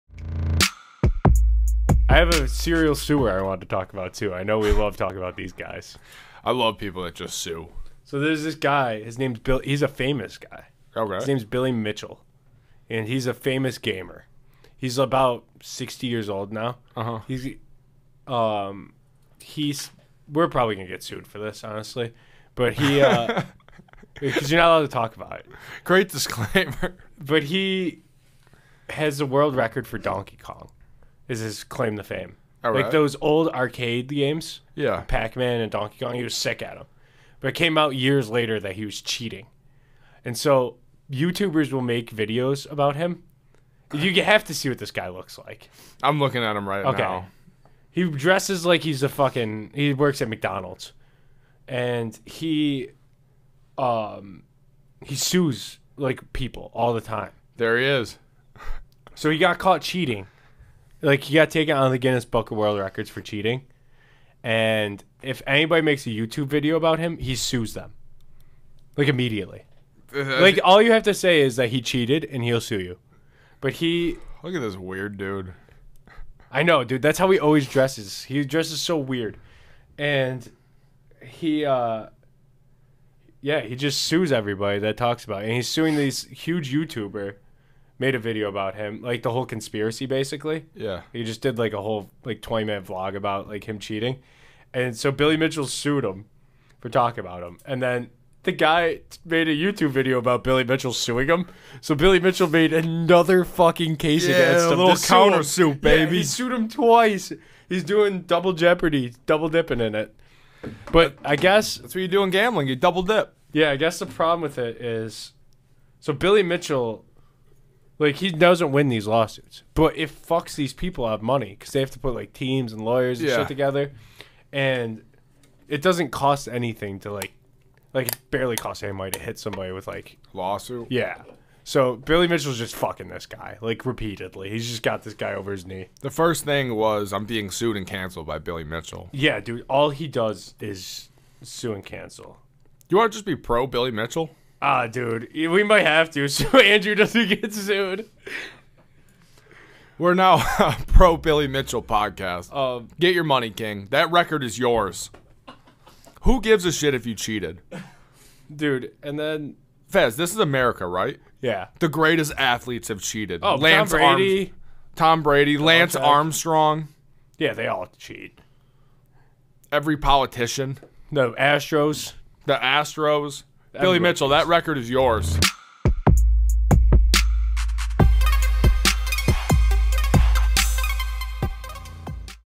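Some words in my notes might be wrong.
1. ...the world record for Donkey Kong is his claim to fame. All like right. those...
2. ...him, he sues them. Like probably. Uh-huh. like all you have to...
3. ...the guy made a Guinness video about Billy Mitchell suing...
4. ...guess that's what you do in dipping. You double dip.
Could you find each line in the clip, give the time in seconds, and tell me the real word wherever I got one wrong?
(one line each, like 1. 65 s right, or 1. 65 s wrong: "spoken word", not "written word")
1. 29 s right
2. 66 s wrong: "immediately", not "probably"
3. 98 s wrong: "YouTube", not "Guinness"
4. 111 s wrong: "gambling", not "dipping".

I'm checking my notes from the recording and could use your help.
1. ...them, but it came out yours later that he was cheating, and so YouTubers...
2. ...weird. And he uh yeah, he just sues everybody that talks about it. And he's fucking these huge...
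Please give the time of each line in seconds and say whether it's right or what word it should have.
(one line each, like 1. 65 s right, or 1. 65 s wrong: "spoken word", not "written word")
1. 36 s wrong: "years", not "yours"
2. 78 s wrong: "suing", not "fucking".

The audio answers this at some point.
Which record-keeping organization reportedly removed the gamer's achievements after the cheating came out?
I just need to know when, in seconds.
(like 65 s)
61 s.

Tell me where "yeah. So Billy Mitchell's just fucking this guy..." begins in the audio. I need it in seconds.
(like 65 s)
130 s.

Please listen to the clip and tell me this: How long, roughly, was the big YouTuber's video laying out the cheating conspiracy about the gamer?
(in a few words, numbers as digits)
20 minutes.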